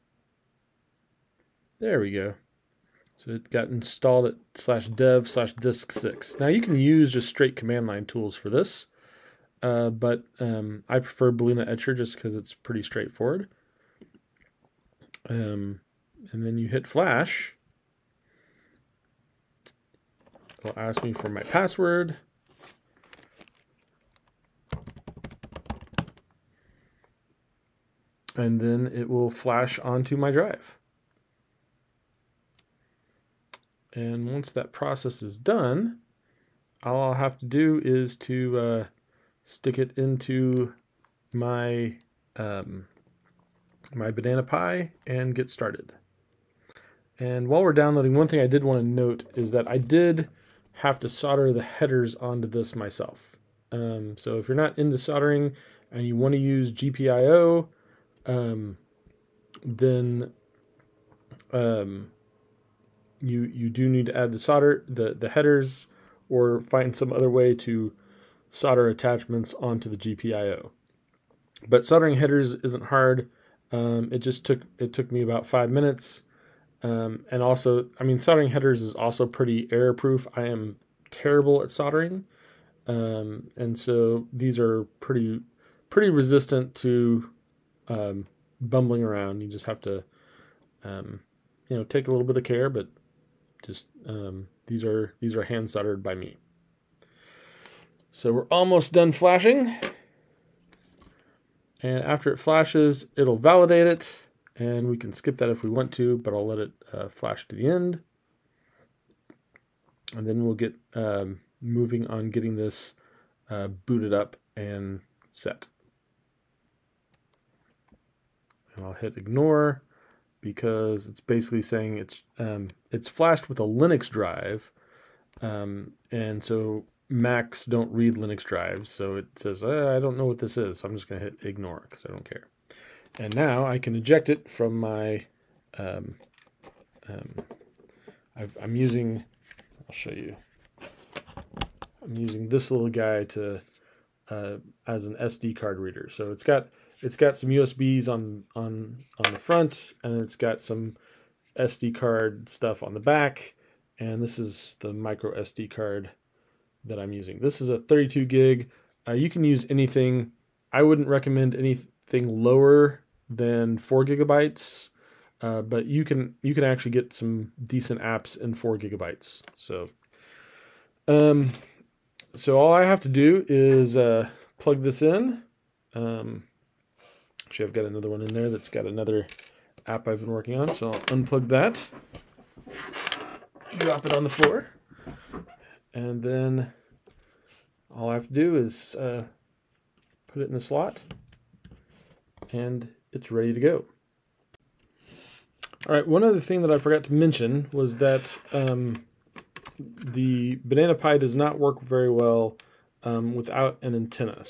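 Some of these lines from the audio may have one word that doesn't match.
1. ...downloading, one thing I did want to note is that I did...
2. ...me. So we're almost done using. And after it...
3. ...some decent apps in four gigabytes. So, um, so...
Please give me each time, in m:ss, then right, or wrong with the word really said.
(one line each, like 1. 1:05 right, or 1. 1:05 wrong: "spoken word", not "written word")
1. 0:47 right
2. 1:36 wrong: "flashing", not "using"
3. 2:47 right.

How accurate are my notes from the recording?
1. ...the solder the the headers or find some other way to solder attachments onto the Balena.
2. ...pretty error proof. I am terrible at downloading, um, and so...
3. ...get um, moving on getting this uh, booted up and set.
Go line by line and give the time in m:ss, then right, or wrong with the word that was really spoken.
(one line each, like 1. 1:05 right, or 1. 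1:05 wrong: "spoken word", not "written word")
1. 1:04 wrong: "GPIO", not "Balena"
2. 1:19 wrong: "soldering", not "downloading"
3. 1:50 right.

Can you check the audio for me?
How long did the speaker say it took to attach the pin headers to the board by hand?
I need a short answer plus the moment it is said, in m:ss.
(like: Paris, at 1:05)
5 minutes, at 1:15.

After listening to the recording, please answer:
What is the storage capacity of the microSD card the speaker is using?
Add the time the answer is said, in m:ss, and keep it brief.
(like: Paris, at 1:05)
32 gig, at 2:37.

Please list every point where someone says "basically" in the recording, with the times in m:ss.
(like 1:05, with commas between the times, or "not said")
2:01.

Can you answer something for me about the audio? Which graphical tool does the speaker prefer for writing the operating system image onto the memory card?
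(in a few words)
Balena Etcher.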